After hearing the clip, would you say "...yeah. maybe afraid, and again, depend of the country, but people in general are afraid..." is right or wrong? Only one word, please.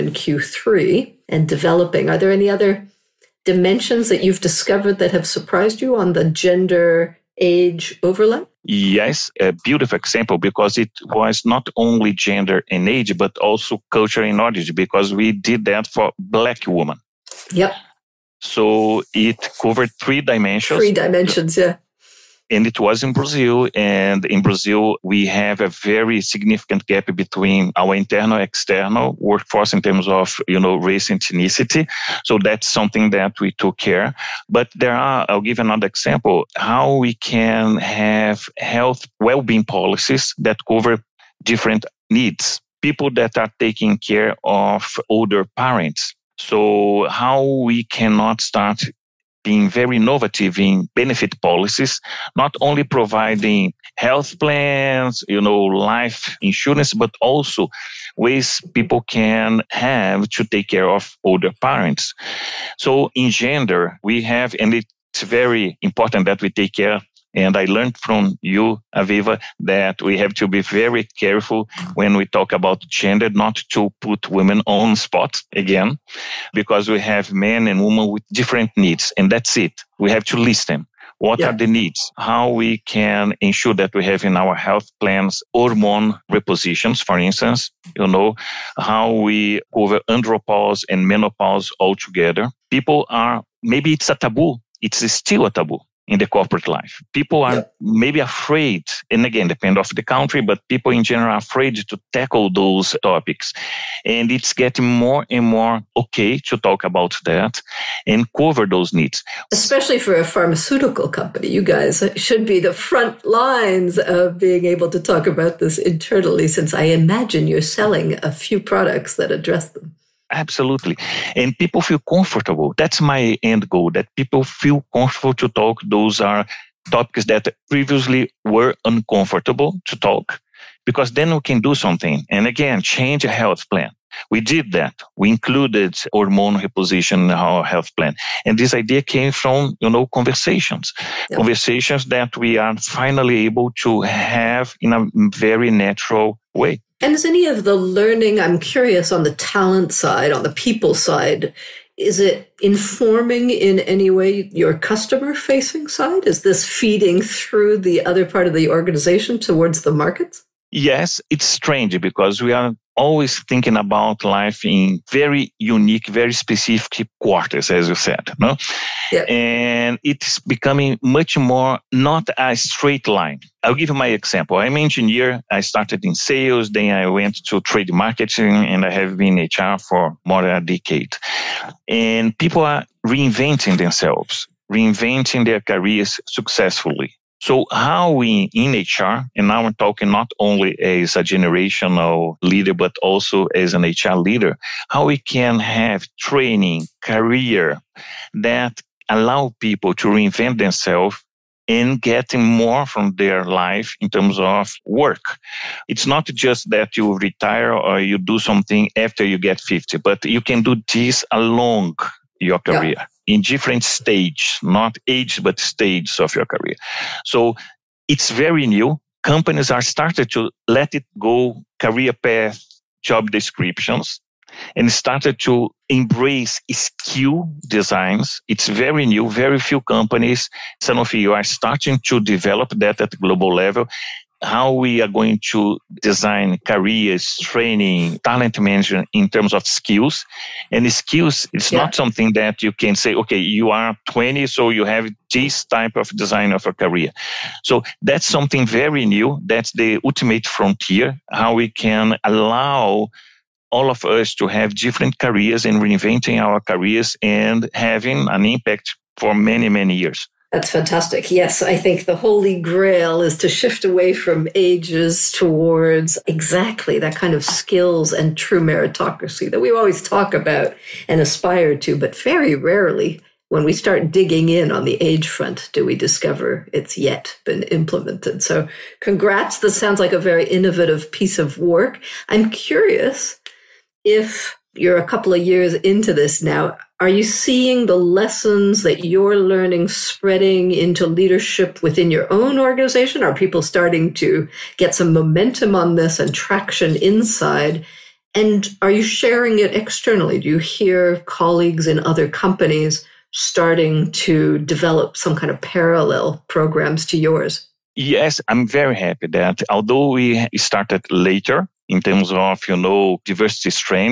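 right.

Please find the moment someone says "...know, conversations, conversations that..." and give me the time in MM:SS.
02:19.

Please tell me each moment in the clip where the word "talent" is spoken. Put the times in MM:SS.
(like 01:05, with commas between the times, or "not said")
02:29, 03:58.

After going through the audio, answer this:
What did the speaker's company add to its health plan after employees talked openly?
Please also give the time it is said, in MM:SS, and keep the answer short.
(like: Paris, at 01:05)
hormone reposition, at 02:15.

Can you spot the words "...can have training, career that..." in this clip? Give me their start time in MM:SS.
03:15.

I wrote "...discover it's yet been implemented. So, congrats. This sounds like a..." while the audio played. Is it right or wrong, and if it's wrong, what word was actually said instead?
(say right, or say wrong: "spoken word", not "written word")
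right.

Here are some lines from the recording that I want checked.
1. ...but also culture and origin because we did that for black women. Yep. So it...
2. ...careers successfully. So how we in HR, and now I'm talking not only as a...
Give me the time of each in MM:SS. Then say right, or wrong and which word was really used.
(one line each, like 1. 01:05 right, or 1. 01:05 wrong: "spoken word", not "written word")
1. 00:13 right
2. 03:05 right.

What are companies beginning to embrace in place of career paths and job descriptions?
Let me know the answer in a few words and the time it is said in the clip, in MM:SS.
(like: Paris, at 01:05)
skill designs, at 03:44.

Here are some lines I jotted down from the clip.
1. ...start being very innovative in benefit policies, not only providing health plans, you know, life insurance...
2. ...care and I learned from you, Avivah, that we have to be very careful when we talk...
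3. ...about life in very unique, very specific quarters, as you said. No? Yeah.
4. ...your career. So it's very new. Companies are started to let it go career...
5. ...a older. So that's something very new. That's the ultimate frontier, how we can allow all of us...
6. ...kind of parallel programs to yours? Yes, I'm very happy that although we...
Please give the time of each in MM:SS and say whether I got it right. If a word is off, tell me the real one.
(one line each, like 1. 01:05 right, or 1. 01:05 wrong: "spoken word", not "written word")
1. 00:48 right
2. 01:06 right
3. 02:43 right
4. 03:36 right
5. 04:06 wrong: "career", not "older"
6. 05:05 right.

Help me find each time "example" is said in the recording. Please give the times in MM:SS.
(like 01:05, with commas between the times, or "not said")
00:09, 00:35, 02:54.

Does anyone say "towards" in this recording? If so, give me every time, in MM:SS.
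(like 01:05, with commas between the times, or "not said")
02:39, 04:25.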